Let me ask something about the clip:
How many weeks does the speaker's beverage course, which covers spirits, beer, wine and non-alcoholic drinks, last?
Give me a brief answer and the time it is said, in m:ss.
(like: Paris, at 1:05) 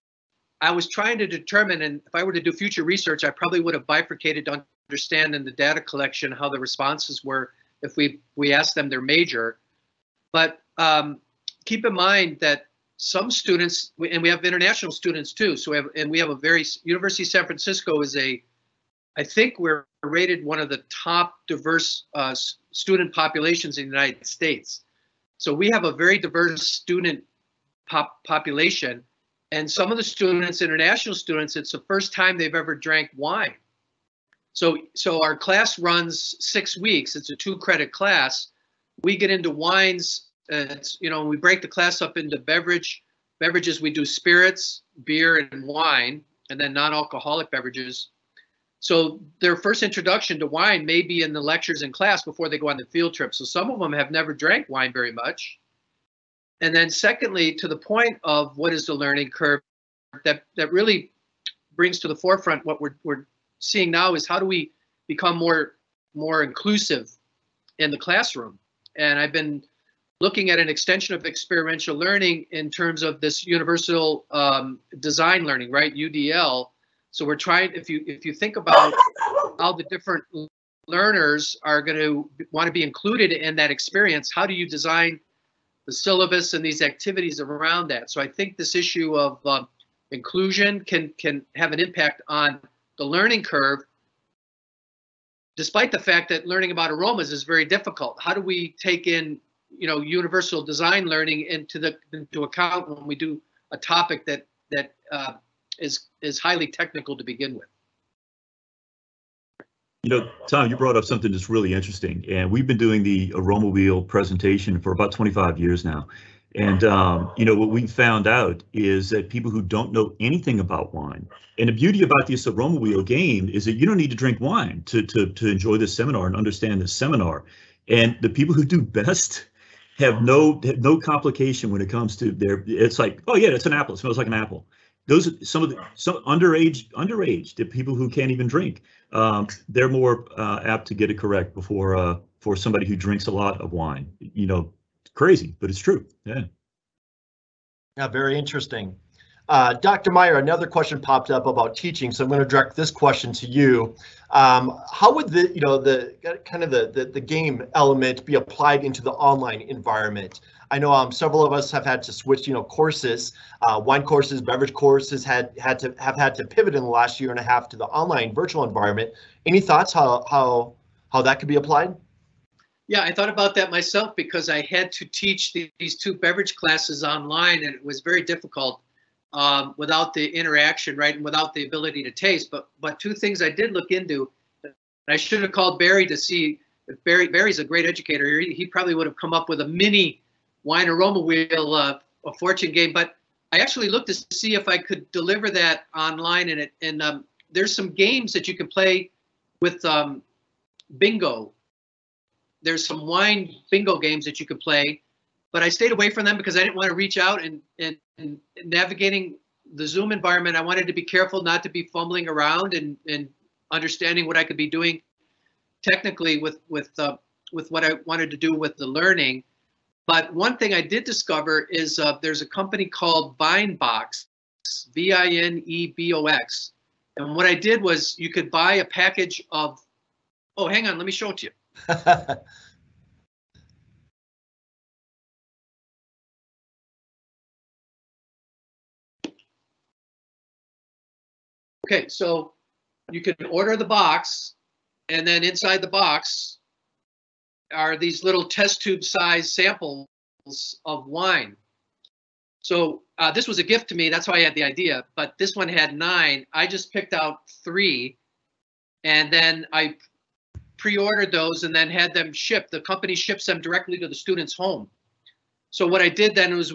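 6, at 0:36.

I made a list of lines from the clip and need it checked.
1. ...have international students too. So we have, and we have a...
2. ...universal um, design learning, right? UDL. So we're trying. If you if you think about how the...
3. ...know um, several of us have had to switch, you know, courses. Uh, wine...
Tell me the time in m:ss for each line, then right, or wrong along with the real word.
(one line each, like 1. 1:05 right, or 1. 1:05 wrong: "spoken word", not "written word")
1. 0:14 right
2. 1:13 right
3. 2:40 right.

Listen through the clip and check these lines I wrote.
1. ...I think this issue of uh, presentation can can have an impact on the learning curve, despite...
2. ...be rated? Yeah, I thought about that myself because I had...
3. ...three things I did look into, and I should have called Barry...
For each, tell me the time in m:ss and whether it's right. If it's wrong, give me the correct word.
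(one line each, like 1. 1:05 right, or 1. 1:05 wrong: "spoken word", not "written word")
1. 1:28 wrong: "inclusion", not "presentation"
2. 2:51 wrong: "applied", not "rated"
3. 3:02 wrong: "two", not "three".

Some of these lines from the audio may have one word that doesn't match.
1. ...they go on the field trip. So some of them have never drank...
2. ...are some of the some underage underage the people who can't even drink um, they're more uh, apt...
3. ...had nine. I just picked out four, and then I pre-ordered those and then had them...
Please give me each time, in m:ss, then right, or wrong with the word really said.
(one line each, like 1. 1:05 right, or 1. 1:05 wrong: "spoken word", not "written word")
1. 0:52 right
2. 2:15 right
3. 4:15 wrong: "three", not "four".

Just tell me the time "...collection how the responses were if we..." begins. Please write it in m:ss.
0:05.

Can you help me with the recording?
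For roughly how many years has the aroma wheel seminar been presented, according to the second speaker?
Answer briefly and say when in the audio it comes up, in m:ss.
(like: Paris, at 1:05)
25, at 1:55.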